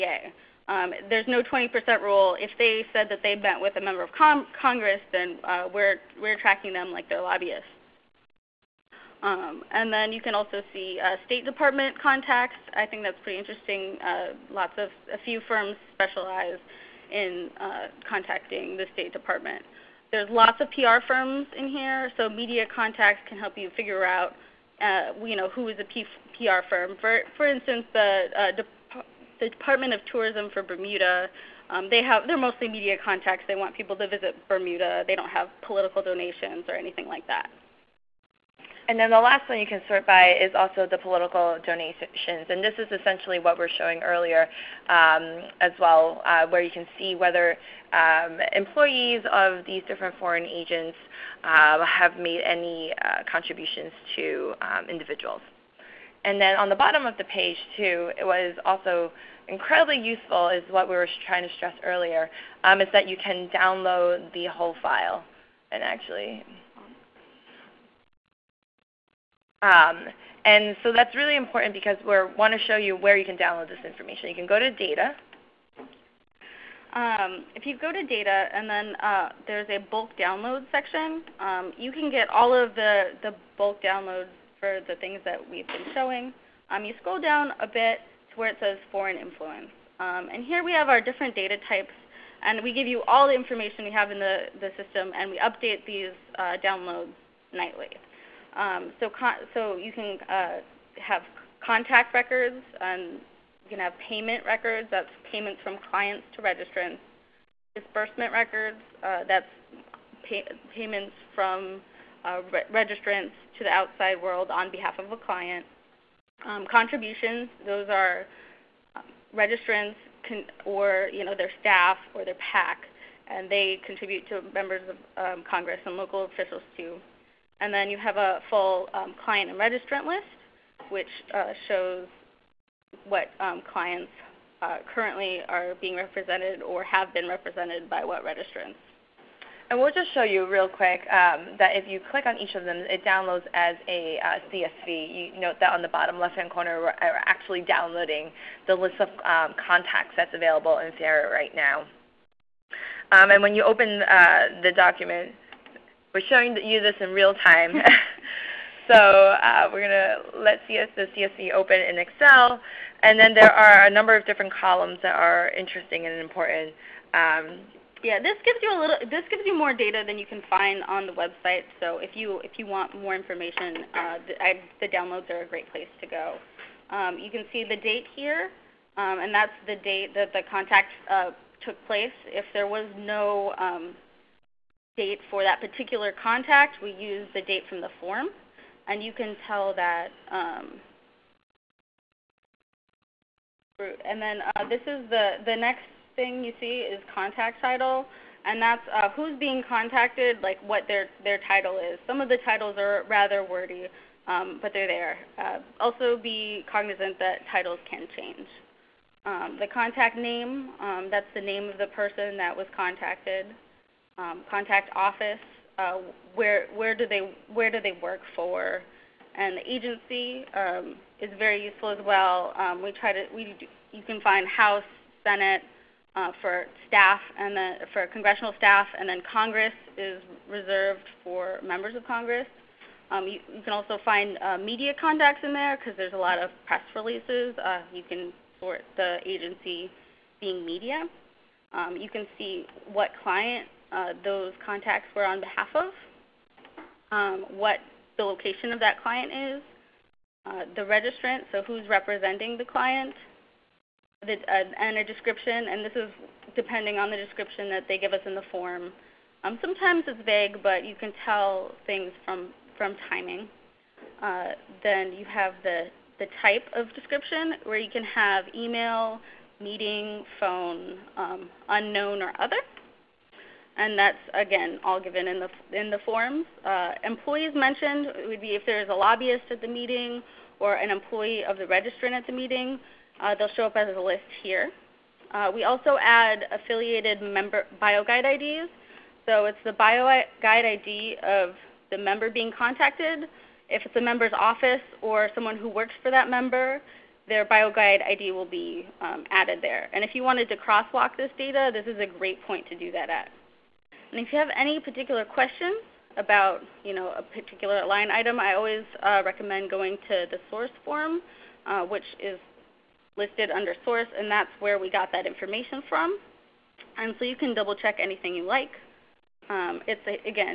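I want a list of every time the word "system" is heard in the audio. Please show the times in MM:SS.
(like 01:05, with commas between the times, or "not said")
01:34.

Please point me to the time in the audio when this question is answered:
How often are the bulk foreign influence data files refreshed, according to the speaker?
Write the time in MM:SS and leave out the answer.
01:37.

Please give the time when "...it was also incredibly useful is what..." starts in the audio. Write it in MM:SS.
00:58.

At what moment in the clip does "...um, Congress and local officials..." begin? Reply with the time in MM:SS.
02:05.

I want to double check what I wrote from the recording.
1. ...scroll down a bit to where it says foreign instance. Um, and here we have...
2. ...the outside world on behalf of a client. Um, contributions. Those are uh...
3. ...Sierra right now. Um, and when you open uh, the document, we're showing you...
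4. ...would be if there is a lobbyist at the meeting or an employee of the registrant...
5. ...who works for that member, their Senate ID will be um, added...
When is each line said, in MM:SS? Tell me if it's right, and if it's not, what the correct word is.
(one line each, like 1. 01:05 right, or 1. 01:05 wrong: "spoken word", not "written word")
1. 01:27 wrong: "influence", not "instance"
2. 01:53 right
3. 02:30 right
4. 04:38 right
5. 04:55 wrong: "BioGuide", not "Senate".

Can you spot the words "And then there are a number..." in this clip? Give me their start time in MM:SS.
02:43.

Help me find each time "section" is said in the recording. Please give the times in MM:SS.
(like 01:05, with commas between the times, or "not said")
01:20.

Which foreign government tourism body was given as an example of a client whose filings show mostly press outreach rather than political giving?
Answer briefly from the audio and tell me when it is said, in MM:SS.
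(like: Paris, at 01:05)
Department of Tourism for Bermuda, at 00:29.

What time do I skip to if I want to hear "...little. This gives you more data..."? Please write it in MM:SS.
02:48.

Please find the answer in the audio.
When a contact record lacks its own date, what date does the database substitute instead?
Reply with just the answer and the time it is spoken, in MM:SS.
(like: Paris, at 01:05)
The date from the form, at 03:07.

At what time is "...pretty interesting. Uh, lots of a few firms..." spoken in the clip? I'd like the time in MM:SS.
00:13.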